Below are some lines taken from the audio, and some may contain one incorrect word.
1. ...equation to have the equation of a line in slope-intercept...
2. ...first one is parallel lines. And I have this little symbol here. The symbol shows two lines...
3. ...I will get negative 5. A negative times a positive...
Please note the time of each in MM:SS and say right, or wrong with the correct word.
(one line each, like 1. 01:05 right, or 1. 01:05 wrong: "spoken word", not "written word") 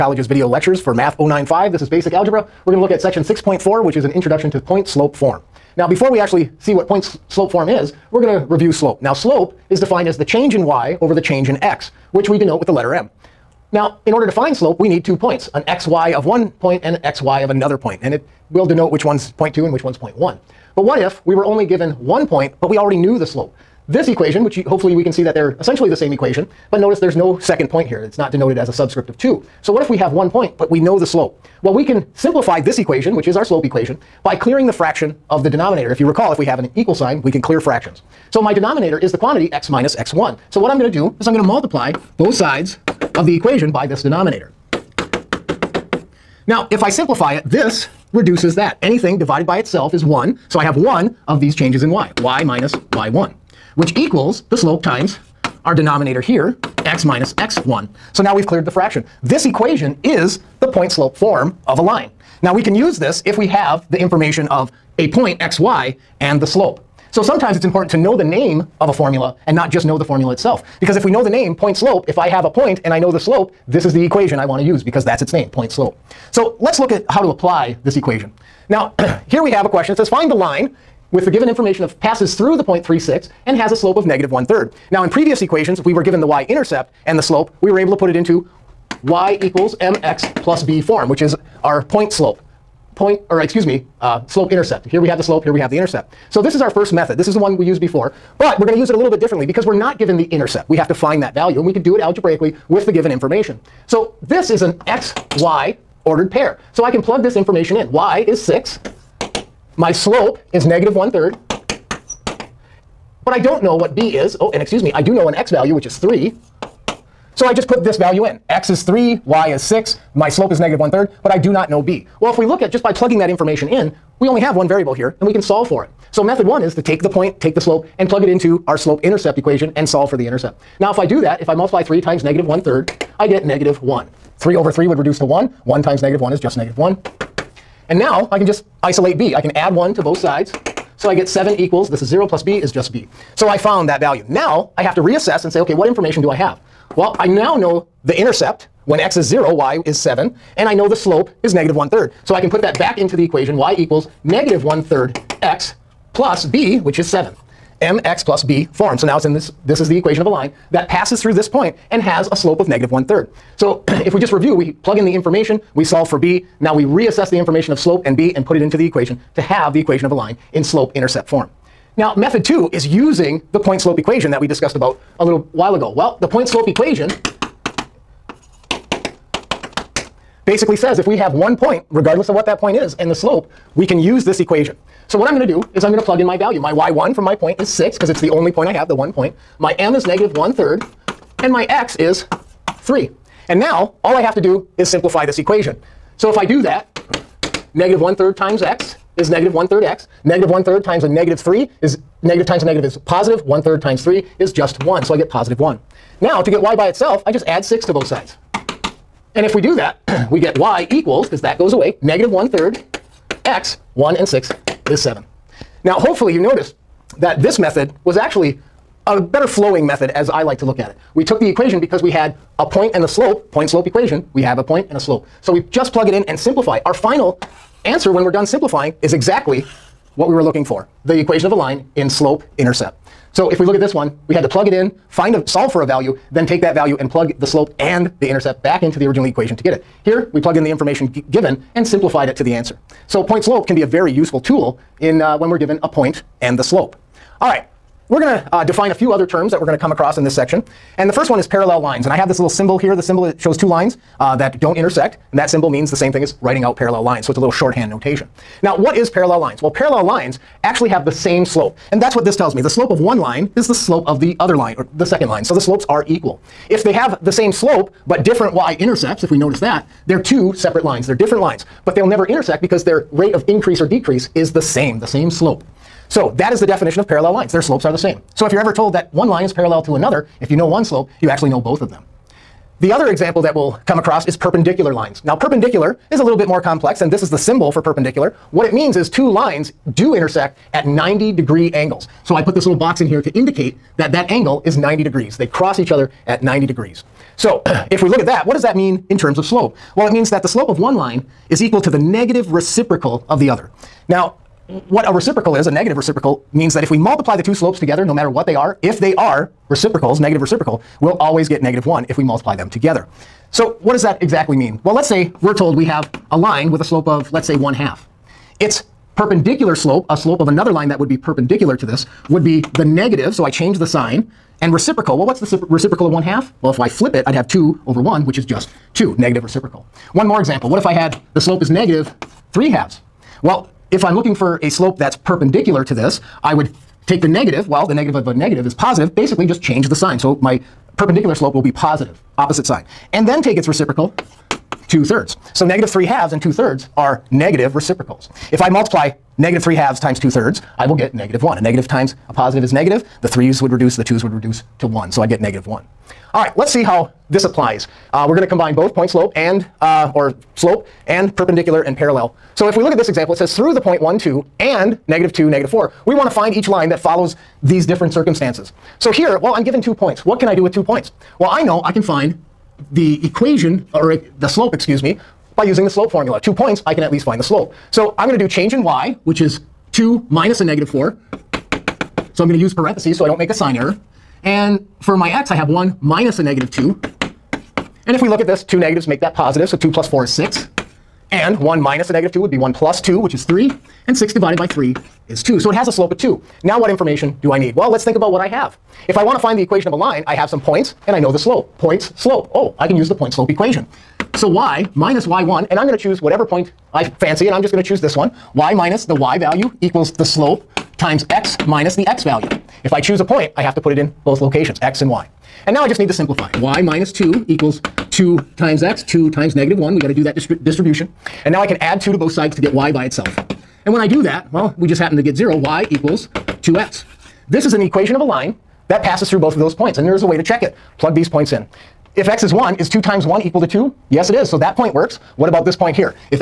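1. 02:48 right
2. 04:11 right
3. 05:50 wrong: "1", not "5".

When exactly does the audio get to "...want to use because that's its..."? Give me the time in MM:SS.
01:14.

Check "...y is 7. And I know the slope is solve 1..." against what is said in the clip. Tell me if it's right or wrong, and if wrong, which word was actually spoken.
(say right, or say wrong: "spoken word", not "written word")
wrong: "negative", not "solve".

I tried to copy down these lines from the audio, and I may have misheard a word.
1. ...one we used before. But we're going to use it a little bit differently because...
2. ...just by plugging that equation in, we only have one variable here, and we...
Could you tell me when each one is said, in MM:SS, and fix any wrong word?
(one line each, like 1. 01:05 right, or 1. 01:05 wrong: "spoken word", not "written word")
1. 01:37 right
2. 02:02 wrong: "information", not "equation".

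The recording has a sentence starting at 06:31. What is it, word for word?
And 1 minus a negative 2 would be 1 plus 2, which is 3.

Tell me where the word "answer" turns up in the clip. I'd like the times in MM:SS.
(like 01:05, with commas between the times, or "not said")
03:47, 04:02.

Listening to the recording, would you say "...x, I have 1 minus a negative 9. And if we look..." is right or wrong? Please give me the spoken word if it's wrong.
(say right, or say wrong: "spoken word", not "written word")
wrong: "2", not "9".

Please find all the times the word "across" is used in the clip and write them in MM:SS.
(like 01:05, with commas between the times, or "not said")
04:09, 04:43.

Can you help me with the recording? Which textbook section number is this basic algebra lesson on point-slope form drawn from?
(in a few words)
6.4.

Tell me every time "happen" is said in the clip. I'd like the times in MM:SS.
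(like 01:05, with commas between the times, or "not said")
07:04.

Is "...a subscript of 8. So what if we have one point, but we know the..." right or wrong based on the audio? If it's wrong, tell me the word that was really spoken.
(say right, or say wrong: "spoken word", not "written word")
wrong: "2", not "8".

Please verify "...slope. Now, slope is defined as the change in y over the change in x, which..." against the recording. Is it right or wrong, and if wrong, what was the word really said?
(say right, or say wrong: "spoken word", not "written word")
right.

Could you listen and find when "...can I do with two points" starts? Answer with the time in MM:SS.
06:10.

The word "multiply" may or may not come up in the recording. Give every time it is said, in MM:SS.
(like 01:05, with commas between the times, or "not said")
00:41, 02:11, 05:06, 05:12, 05:48.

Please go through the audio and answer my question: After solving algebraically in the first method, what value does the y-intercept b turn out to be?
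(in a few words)
7.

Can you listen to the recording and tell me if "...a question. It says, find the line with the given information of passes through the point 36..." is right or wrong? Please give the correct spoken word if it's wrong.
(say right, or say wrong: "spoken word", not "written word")
right.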